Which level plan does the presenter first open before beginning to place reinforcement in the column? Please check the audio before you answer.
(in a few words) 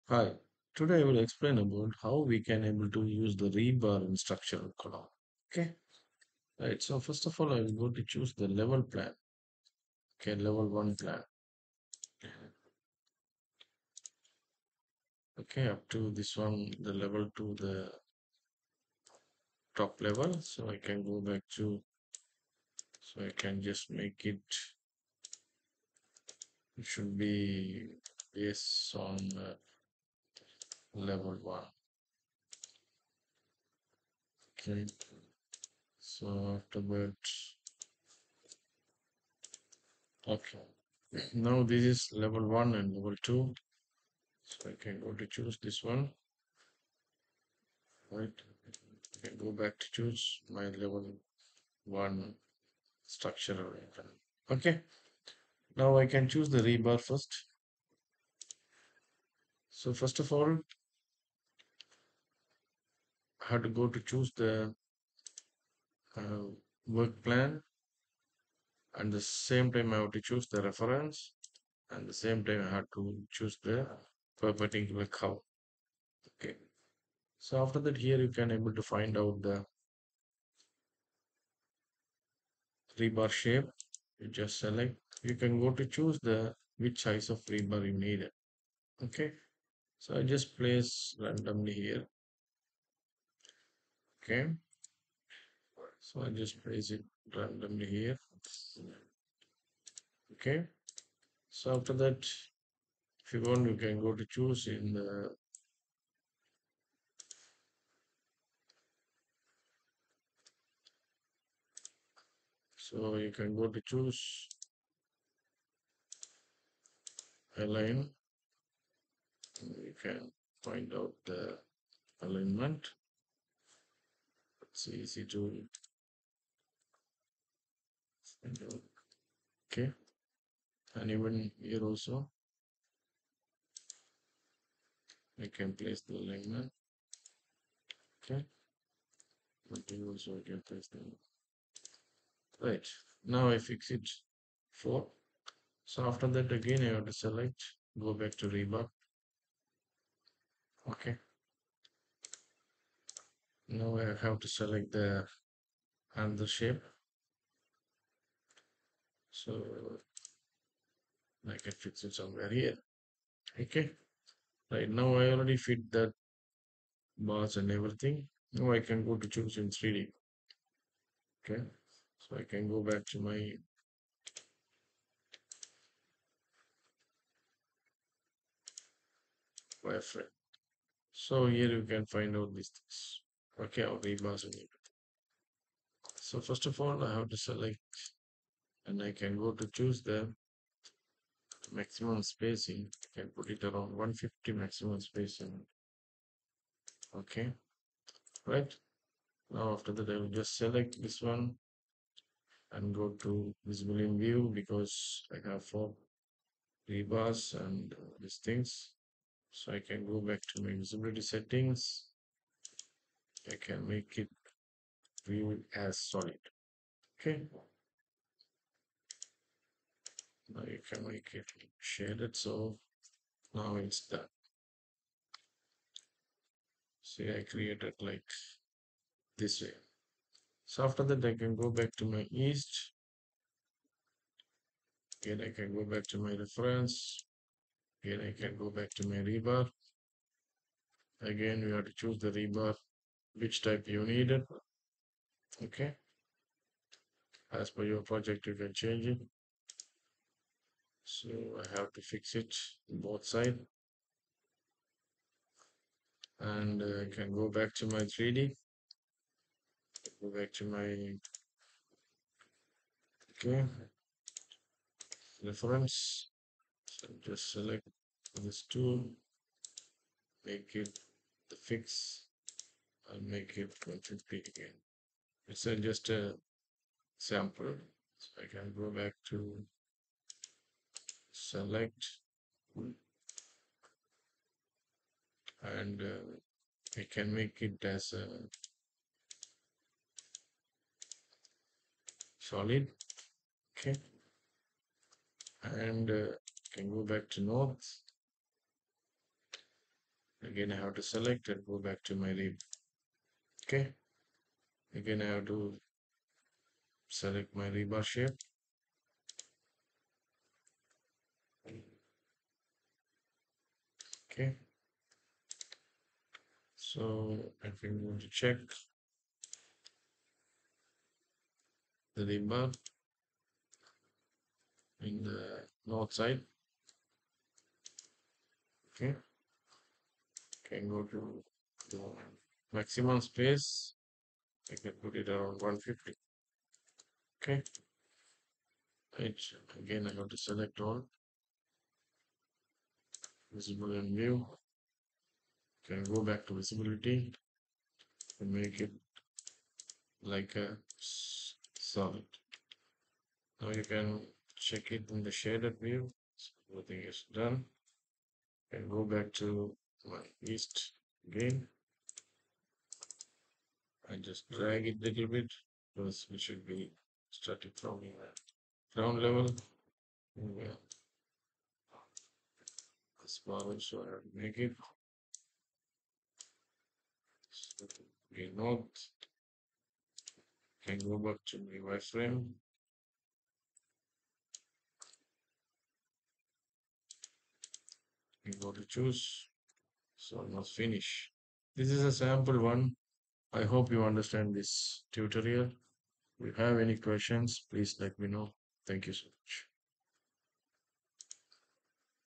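Level one plan.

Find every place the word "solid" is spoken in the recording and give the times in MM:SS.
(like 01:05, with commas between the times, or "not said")
03:35, 04:52, 05:50.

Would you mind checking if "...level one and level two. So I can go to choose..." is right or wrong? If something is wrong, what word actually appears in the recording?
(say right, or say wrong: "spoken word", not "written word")
right.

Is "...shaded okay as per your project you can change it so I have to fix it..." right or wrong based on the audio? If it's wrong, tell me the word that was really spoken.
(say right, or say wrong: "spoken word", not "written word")
wrong: "needed", not "shaded".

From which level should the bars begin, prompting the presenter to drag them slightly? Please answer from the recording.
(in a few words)
Ground level.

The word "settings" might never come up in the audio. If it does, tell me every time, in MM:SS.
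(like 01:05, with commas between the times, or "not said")
03:31.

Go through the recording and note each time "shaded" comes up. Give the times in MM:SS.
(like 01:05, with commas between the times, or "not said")
03:41, 05:55.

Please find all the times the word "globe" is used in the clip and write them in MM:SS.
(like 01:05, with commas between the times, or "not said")
not said.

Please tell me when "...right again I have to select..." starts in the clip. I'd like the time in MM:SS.
05:39.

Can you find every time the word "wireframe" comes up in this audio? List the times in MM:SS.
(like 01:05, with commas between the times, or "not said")
02:59, 06:21.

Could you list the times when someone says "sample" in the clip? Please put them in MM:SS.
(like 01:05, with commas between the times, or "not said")
04:37, 06:32.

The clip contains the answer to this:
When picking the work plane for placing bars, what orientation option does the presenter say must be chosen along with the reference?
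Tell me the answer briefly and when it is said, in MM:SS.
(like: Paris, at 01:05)
Perpendicular, at 01:14.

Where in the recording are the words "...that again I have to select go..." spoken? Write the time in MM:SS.
02:26.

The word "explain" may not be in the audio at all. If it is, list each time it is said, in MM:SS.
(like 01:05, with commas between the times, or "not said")
00:01.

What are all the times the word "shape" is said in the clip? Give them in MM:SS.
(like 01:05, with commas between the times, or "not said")
01:23, 02:36, 05:08.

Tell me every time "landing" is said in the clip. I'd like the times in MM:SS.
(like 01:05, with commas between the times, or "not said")
not said.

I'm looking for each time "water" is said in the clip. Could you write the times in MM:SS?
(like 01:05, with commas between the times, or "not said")
not said.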